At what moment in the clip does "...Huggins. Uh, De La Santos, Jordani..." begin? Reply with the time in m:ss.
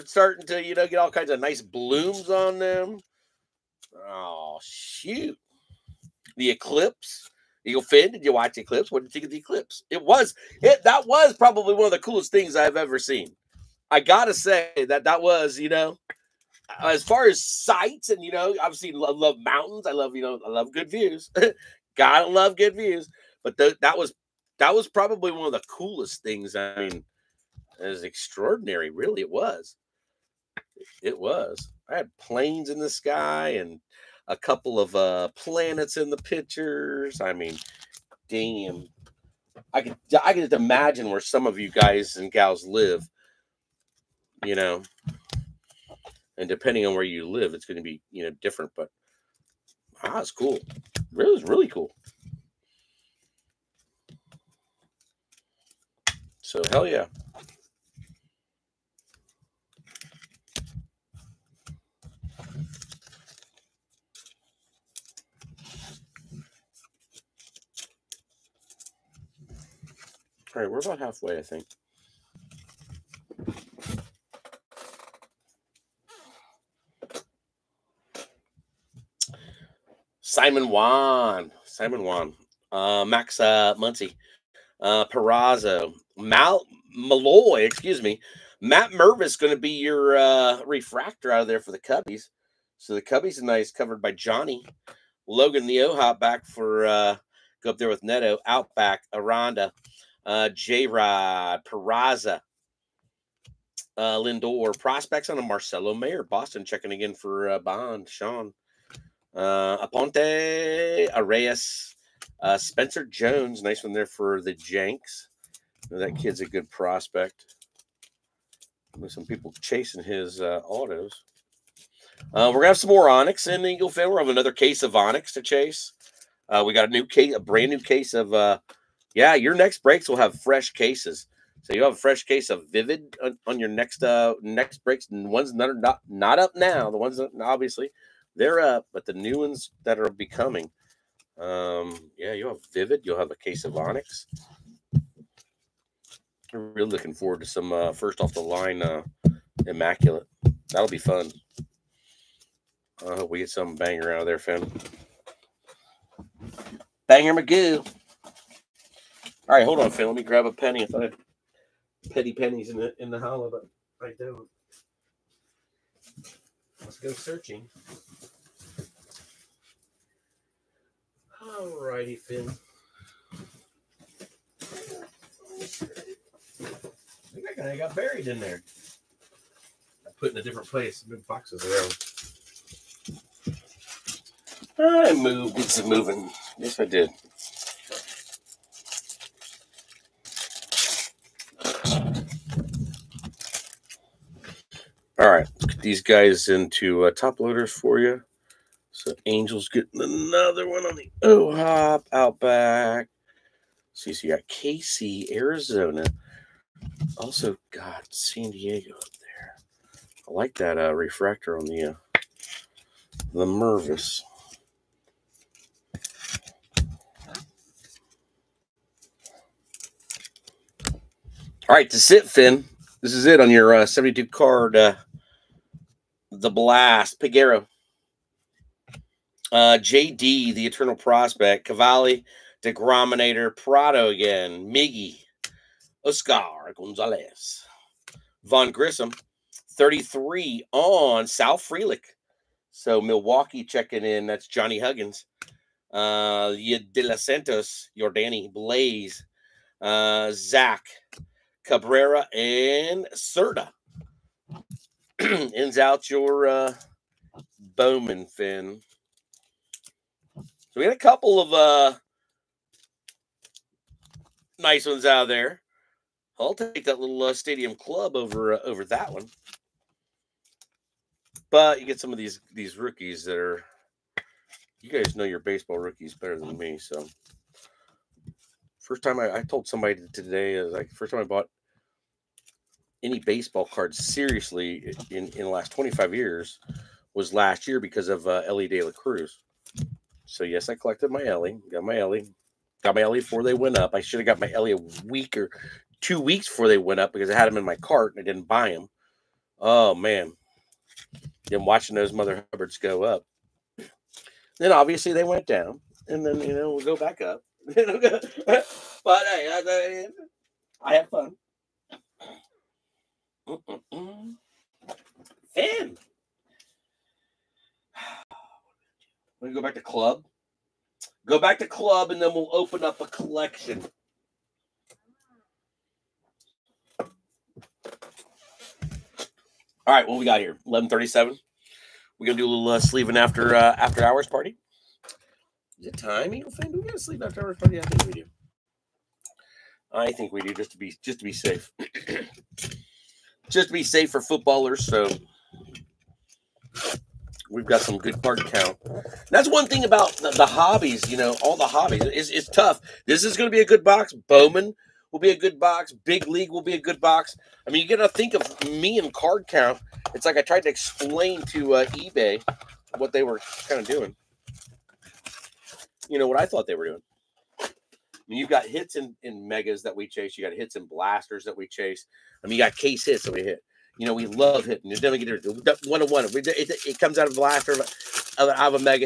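4:04.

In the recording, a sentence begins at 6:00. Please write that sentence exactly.
It's like I tried to explain to uh, eBay what they were kind of doing.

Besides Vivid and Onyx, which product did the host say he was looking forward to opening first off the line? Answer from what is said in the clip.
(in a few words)
Immaculate.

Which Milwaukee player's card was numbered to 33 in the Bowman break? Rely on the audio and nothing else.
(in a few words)
Sal Frelick.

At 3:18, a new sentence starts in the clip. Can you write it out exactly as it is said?
So Angel's getting another one on the O-Hop out back.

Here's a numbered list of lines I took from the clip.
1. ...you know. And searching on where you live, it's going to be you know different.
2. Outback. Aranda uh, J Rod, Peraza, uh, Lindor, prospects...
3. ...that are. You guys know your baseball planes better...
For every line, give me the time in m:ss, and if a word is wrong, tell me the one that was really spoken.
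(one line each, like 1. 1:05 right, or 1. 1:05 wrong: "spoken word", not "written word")
1. 0:44 wrong: "depending", not "searching"
2. 1:38 right
3. 4:33 wrong: "rookies", not "planes".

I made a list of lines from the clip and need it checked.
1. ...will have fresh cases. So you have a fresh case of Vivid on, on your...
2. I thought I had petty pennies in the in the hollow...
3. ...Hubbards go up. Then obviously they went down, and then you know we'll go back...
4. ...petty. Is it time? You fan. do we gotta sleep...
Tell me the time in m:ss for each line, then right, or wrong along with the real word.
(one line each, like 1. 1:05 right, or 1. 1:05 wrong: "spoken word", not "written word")
1. 2:10 right
2. 2:40 right
3. 5:02 right
4. 5:34 wrong: "party", not "petty".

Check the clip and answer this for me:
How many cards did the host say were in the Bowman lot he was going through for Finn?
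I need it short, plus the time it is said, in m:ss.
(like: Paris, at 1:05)
72, at 3:43.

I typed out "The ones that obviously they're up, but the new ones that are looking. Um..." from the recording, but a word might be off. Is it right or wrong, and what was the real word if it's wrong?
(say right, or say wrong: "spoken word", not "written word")
wrong: "becoming", not "looking".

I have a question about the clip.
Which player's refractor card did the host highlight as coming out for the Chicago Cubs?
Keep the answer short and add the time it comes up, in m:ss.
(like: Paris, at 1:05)
Matt Mervis, at 1:28.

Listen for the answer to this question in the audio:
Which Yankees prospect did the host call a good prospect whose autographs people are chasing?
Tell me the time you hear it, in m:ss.
1:52.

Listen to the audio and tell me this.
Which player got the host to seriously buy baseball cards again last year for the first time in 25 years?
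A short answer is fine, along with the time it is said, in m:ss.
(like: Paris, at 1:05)
Elly De La Cruz, at 4:48.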